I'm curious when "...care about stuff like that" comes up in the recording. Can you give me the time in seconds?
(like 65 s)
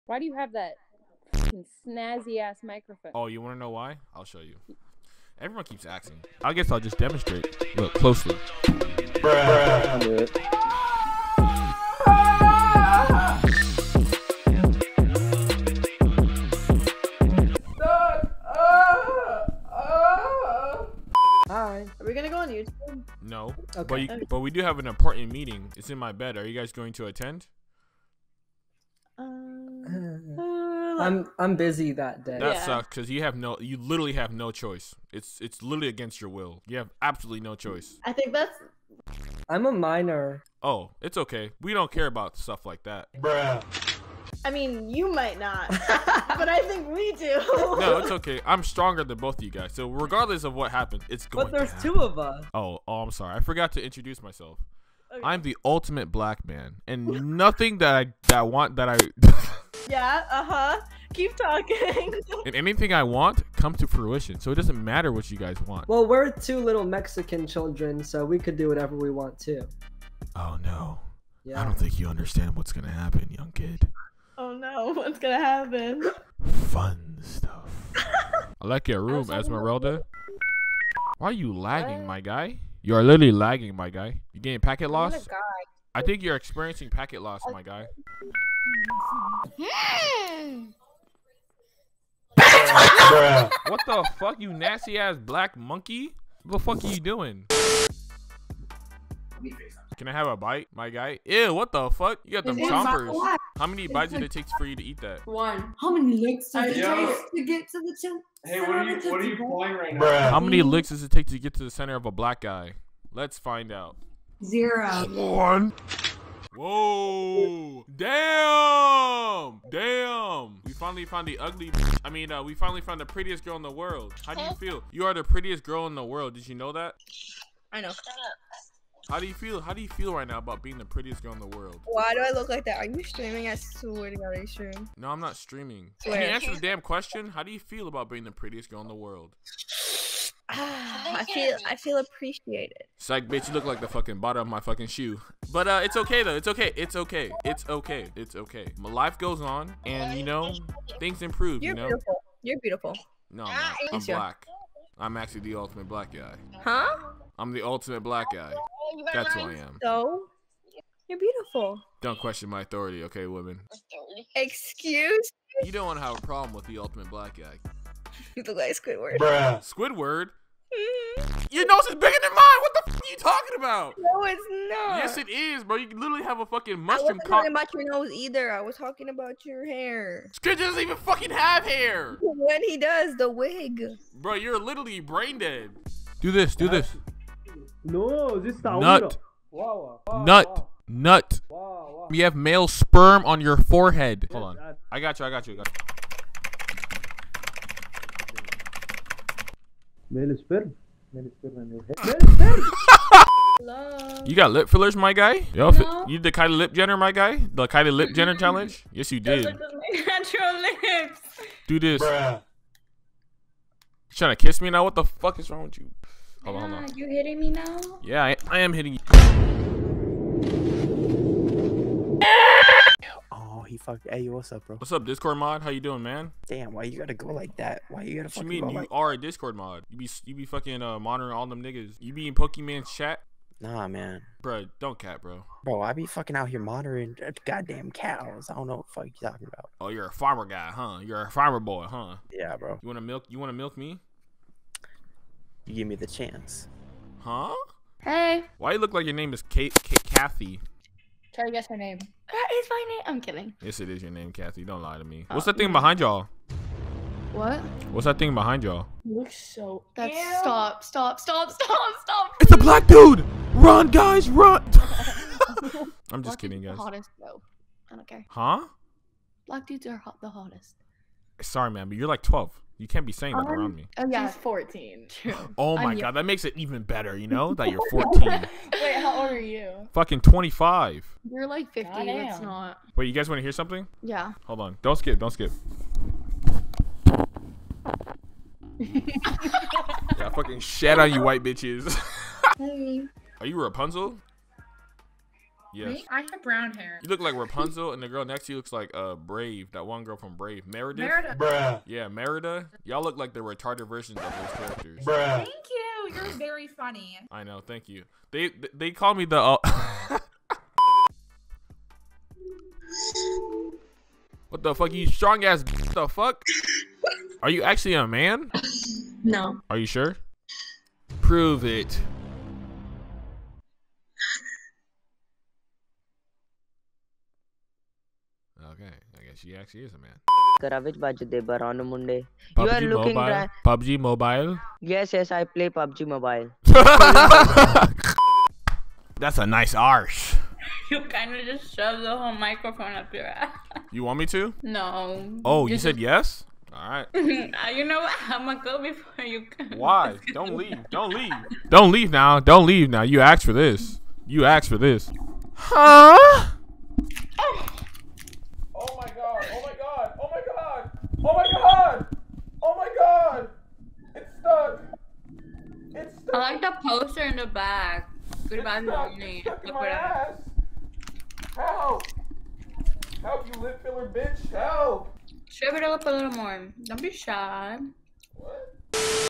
41 s.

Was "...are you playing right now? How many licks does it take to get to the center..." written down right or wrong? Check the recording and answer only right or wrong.
right.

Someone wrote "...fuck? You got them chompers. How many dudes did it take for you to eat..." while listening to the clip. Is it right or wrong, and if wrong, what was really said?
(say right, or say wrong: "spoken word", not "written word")
wrong: "bites", not "dudes".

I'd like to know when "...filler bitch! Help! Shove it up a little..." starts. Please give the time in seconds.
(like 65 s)
373 s.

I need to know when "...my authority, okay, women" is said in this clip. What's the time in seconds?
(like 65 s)
162 s.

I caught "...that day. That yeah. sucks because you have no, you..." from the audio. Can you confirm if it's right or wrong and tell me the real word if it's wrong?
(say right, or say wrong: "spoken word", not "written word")
right.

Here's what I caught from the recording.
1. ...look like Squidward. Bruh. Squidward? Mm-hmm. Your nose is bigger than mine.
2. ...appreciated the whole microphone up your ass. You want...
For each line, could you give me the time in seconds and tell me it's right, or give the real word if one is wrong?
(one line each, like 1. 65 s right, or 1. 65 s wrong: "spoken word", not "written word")
1. 168 s right
2. 341 s wrong: "shoved", not "appreciated".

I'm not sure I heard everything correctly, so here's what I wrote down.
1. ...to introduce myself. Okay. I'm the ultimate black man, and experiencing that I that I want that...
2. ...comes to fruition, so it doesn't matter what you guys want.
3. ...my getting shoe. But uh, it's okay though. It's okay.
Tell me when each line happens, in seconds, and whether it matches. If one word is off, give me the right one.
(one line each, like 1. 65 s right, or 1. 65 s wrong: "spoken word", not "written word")
1. 53 s wrong: "nothing", not "experiencing"
2. 63 s right
3. 144 s wrong: "fucking", not "getting".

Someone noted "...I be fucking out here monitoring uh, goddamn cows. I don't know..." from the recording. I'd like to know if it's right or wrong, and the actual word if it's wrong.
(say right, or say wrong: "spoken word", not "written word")
right.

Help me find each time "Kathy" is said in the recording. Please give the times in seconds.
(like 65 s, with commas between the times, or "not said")
250 s, 254 s.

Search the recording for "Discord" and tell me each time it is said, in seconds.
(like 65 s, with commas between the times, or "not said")
225 s, 229 s.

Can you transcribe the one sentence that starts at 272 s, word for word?
You can't be saying that um, around me.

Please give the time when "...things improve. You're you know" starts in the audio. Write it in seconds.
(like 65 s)
150 s.